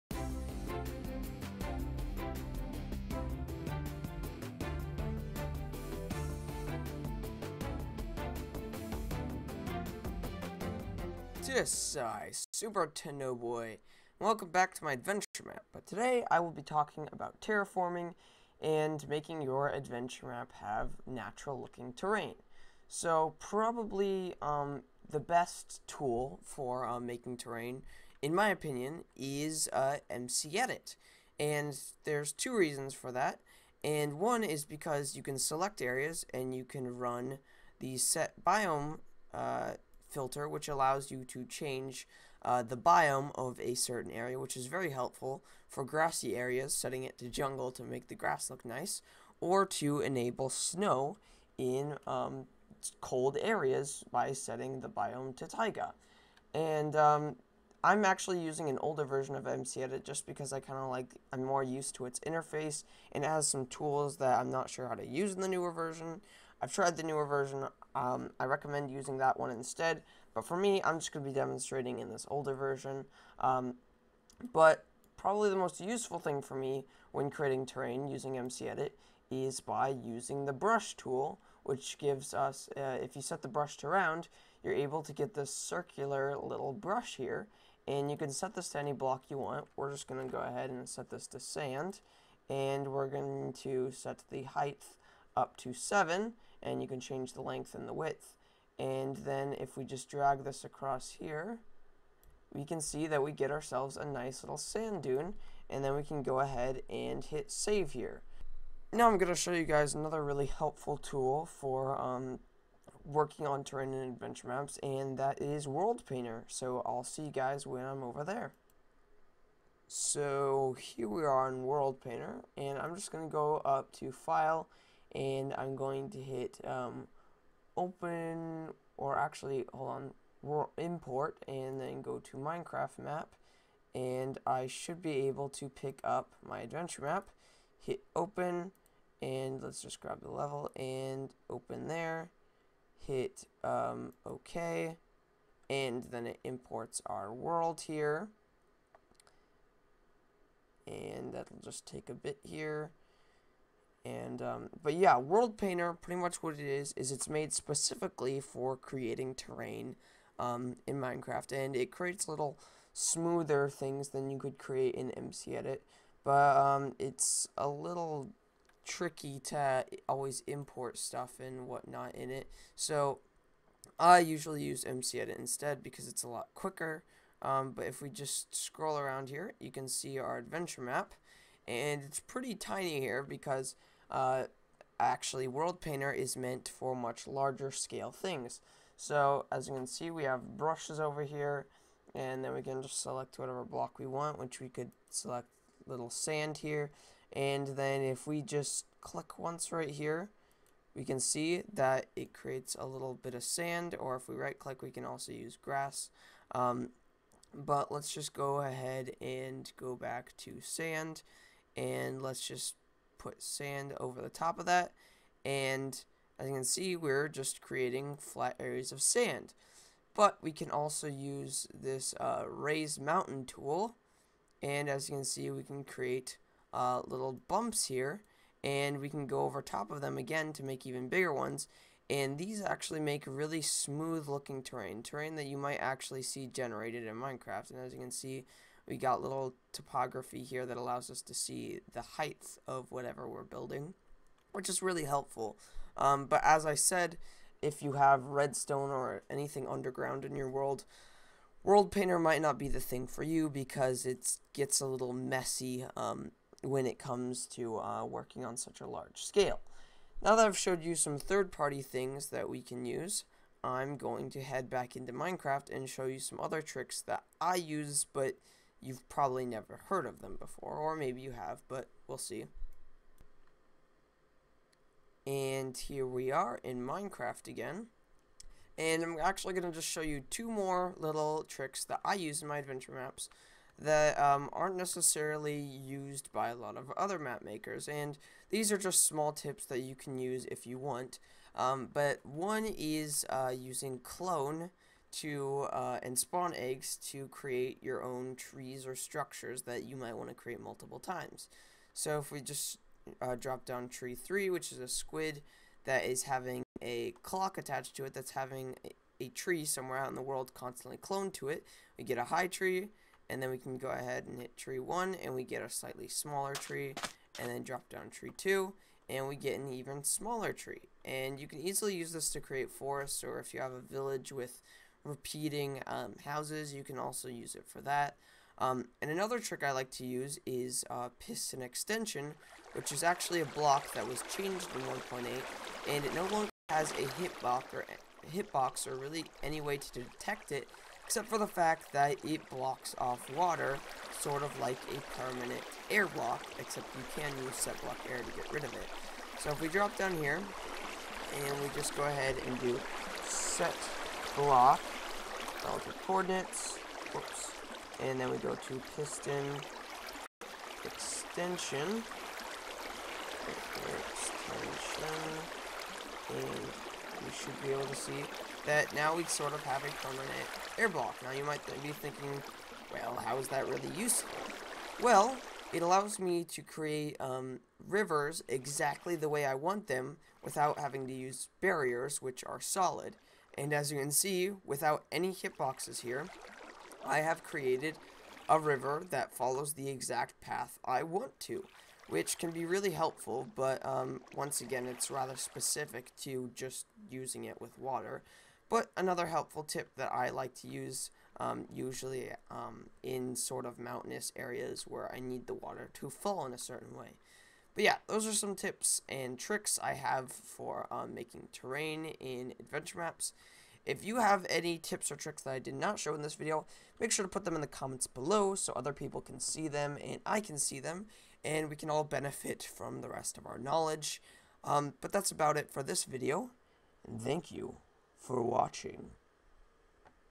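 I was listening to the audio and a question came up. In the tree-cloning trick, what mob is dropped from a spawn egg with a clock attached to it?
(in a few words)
A squid.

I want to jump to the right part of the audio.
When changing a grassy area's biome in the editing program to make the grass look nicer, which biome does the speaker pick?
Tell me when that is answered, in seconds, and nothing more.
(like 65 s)
47 s.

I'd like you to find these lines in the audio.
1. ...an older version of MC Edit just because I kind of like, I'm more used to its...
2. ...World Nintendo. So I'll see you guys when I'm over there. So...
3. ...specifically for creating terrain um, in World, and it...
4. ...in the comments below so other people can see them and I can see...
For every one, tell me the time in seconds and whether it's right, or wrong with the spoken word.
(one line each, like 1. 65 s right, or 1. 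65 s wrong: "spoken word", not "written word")
1. 58 s right
2. 115 s wrong: "Painter", not "Nintendo"
3. 157 s wrong: "Minecraft", not "World"
4. 417 s right.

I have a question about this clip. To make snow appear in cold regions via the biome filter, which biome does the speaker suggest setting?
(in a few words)
Taiga.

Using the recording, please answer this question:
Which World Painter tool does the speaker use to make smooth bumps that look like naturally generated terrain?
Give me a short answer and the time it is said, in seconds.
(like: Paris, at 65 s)
Raised mountain tool, at 222 s.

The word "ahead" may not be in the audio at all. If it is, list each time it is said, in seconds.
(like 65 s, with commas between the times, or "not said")
90 s, 106 s, 208 s, 313 s, 352 s.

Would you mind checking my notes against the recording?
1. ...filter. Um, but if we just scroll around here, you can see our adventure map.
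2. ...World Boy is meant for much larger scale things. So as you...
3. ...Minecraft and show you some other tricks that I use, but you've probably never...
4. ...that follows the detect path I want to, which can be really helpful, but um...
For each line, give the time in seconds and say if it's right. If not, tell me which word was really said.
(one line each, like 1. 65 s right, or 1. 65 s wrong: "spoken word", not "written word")
1. 176 s wrong: "quicker", not "filter"
2. 185 s wrong: "Painter", not "Boy"
3. 265 s right
4. 389 s wrong: "exact", not "detect".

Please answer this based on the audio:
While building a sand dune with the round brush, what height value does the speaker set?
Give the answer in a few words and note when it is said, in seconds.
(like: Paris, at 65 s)
7, at 95 s.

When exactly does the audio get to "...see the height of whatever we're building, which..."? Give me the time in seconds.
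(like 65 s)
241 s.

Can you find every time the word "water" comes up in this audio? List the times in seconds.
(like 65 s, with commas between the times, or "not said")
343 s, 397 s, 405 s.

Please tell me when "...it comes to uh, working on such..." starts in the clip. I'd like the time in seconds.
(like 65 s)
256 s.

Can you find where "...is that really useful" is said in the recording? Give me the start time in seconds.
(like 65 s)
373 s.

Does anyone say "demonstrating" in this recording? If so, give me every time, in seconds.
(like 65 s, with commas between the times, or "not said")
71 s.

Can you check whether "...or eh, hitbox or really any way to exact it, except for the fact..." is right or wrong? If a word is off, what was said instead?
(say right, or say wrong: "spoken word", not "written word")
wrong: "detect", not "exact".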